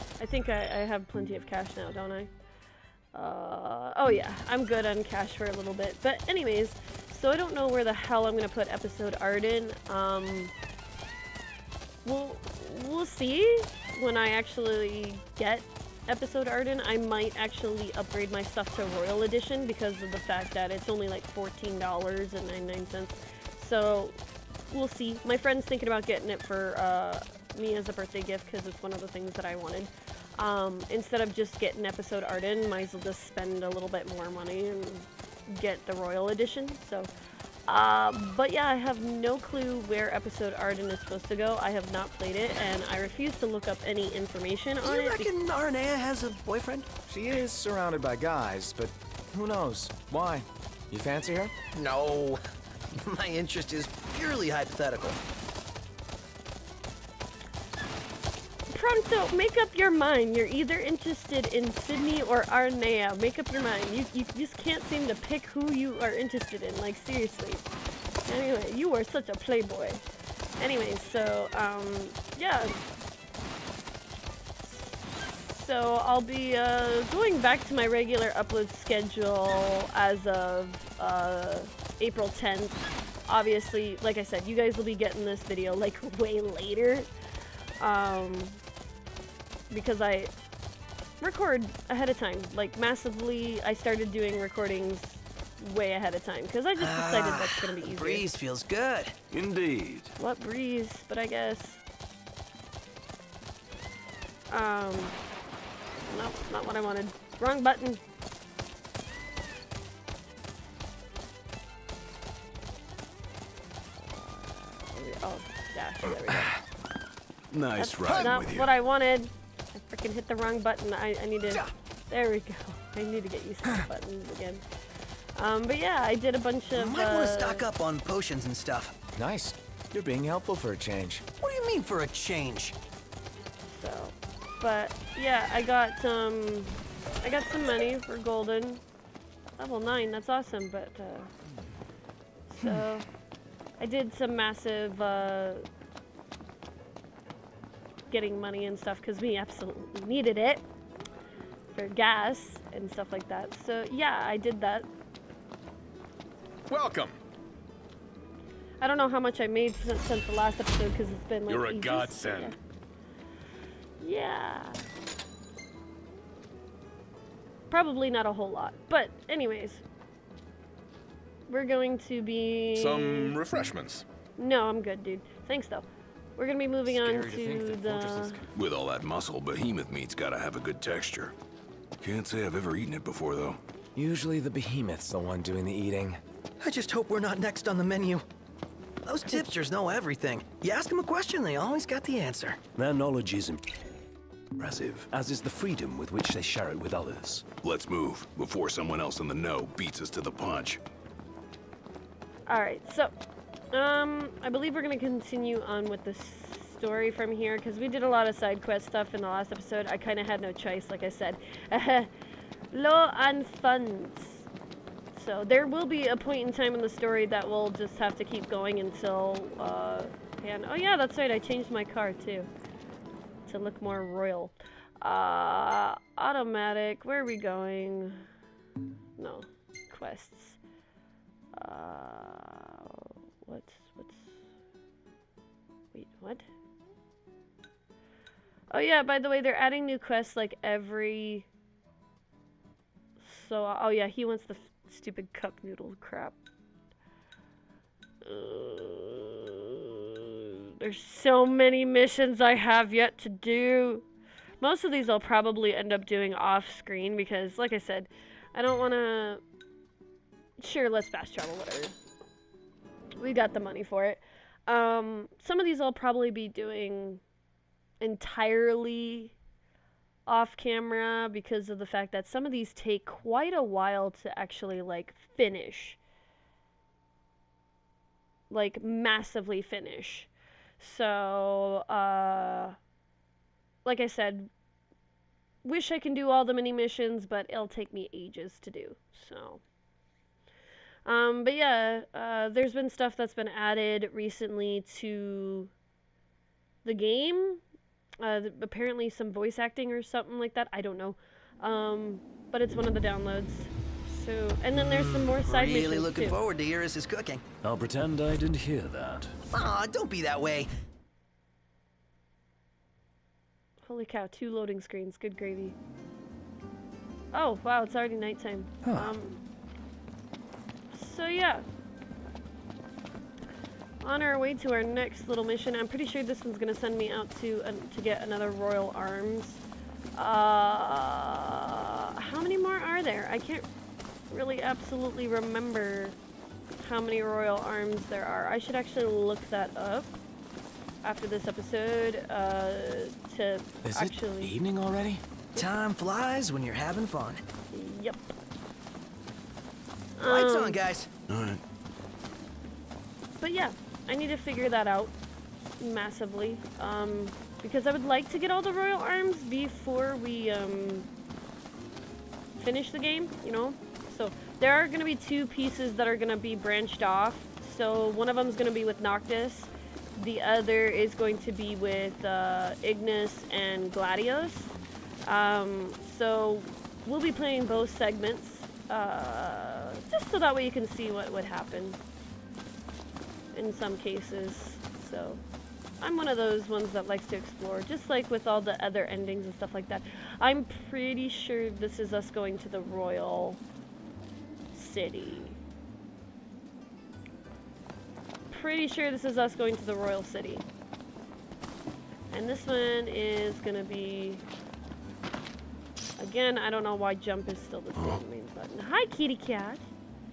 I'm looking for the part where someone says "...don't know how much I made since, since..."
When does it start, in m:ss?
2:38.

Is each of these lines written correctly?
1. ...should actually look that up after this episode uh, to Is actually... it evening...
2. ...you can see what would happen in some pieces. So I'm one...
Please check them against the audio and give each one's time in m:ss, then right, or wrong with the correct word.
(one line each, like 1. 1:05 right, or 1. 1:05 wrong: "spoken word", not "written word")
1. 5:38 right
2. 6:20 wrong: "cases", not "pieces".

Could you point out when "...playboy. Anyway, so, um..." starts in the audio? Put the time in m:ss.
1:09.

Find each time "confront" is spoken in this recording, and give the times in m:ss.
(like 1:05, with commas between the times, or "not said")
not said.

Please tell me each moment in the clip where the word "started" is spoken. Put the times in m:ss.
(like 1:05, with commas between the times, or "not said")
1:33.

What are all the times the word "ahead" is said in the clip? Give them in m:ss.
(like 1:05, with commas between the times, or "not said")
1:31, 1:35.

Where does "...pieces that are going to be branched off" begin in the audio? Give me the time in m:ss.
6:05.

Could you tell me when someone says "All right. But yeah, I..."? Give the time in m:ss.
5:51.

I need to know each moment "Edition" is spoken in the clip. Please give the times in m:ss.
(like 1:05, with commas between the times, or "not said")
0:19, 0:36.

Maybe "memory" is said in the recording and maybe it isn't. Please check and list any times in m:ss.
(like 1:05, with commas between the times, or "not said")
not said.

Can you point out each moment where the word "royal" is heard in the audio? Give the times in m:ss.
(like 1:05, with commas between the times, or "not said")
0:18, 0:35, 3:44, 5:28, 5:37, 5:58, 6:32, 6:39.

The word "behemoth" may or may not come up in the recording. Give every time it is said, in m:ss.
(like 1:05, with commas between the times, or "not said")
2:59, 3:04.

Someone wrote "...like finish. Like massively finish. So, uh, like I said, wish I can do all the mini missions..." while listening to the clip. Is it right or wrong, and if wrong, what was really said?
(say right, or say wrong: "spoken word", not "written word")
right.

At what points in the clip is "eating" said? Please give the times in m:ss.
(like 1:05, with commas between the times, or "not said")
3:05.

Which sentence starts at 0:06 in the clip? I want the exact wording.
But anyways, so I don't know where the hell I'm going to put episode Ardyn.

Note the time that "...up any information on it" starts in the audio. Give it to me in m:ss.
0:43.